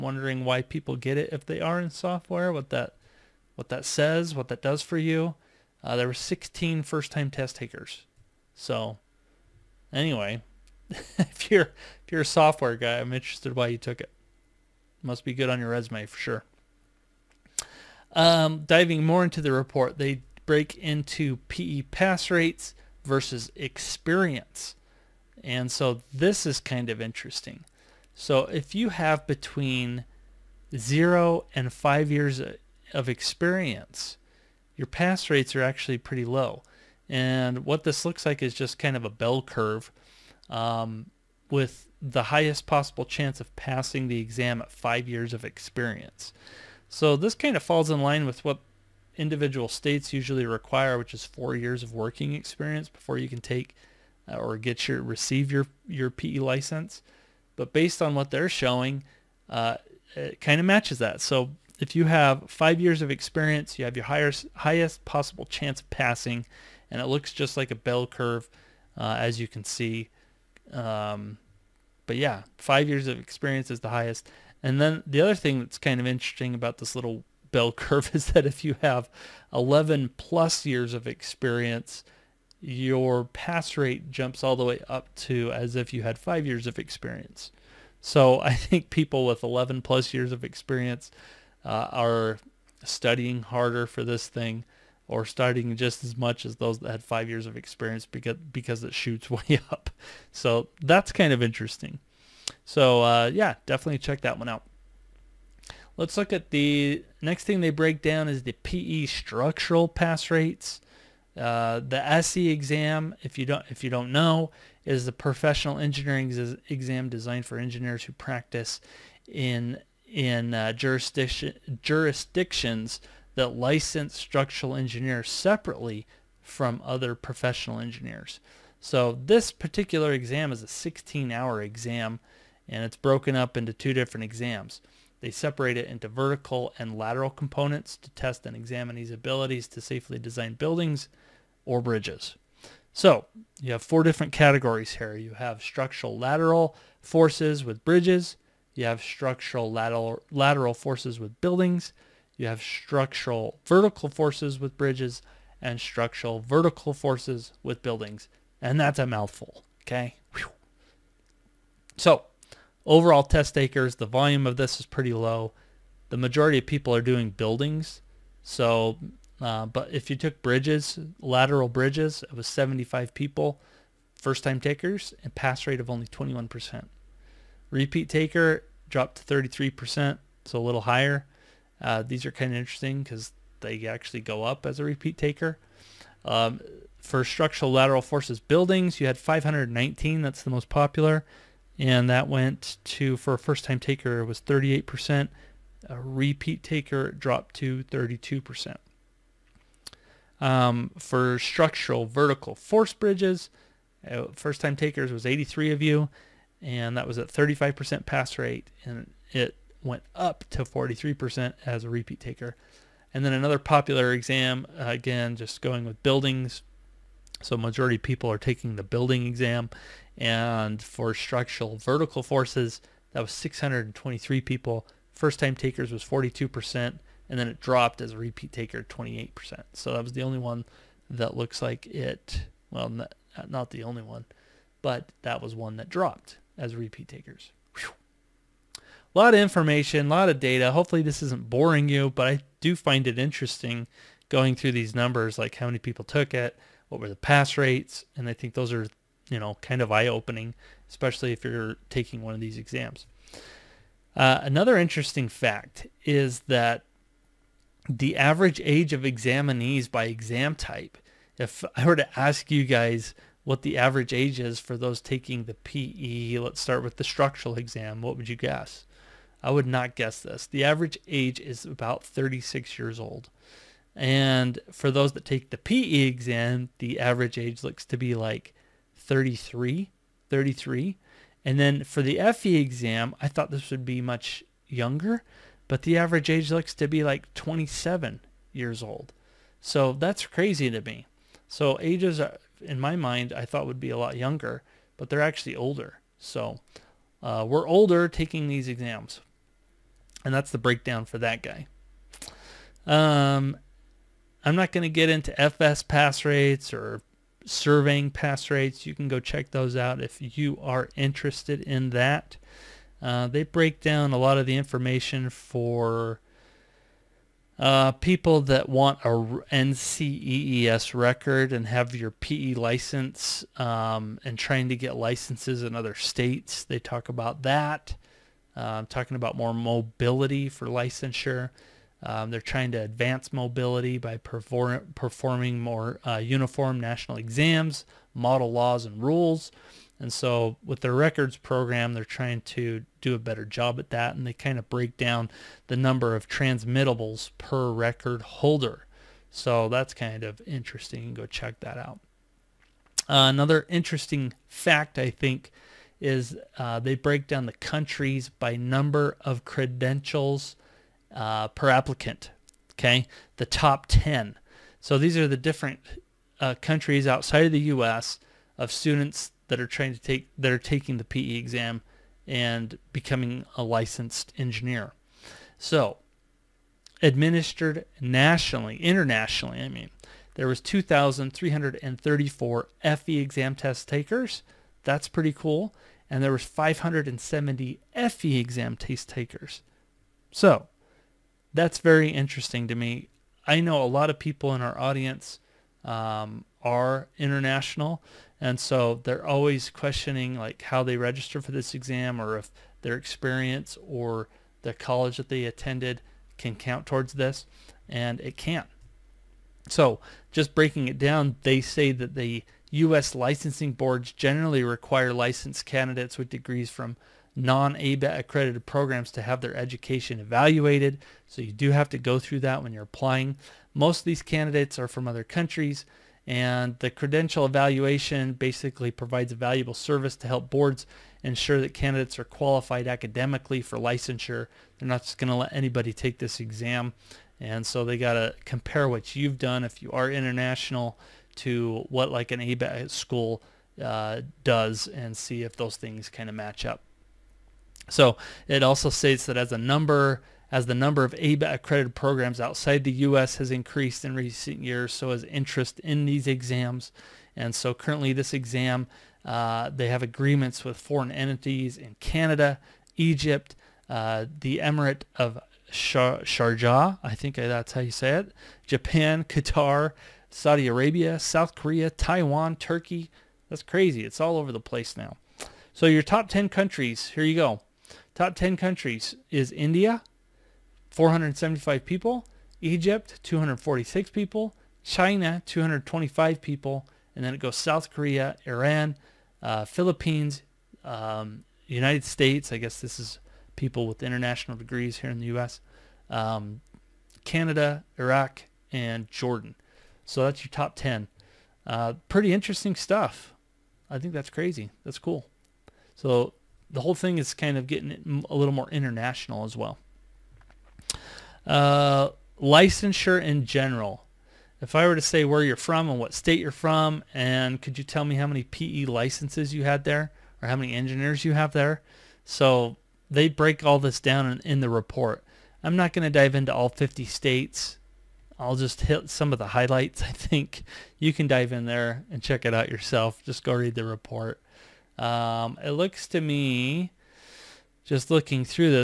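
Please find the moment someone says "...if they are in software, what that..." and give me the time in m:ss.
0:01.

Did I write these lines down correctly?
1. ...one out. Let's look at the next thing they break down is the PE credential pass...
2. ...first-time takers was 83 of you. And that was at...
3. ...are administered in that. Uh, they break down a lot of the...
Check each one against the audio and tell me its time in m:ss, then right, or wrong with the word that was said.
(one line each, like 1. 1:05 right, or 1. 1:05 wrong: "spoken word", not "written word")
1. 1:44 wrong: "structural", not "credential"
2. 3:24 right
3. 5:10 wrong: "interested", not "administered".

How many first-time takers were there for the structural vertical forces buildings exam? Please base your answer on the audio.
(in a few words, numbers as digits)
623.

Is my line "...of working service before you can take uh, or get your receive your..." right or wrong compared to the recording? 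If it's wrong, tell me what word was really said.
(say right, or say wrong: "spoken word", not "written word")
wrong: "experience", not "service".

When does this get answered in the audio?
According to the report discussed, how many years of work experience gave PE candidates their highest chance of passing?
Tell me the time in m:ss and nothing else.
1:02.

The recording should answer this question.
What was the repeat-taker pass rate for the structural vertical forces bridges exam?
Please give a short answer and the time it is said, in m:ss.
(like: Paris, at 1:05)
43%, at 3:30.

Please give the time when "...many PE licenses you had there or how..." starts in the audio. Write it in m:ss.
8:38.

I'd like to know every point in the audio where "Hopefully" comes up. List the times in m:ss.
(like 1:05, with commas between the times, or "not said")
4:00.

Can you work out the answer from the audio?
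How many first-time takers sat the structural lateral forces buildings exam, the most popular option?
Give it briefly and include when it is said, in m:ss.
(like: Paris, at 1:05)
519, at 3:09.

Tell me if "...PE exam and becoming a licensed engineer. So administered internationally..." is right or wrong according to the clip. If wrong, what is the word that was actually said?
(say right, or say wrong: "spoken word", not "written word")
wrong: "nationally", not "internationally".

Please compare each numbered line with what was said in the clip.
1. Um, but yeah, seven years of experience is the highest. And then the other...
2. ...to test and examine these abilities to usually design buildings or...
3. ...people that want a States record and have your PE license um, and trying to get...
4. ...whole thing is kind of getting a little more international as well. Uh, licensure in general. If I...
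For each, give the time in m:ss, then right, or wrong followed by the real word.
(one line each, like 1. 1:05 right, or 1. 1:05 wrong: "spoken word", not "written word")
1. 1:10 wrong: "five", not "seven"
2. 2:17 wrong: "safely", not "usually"
3. 5:17 wrong: "NCEES", not "States"
4. 8:26 right.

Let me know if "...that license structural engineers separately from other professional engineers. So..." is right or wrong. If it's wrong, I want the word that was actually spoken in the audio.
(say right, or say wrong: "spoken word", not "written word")
right.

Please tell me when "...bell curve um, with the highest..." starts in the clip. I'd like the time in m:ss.
0:39.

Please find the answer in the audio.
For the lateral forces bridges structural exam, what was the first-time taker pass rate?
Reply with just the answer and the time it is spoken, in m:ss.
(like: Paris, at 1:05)
21%, at 2:56.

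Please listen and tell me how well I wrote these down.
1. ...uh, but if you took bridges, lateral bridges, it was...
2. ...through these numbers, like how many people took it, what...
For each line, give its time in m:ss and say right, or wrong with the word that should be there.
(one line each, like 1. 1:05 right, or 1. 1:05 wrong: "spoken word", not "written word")
1. 2:49 right
2. 4:04 right.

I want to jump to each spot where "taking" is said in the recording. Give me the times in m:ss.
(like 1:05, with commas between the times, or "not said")
3:38, 4:11, 4:25, 4:58, 6:10.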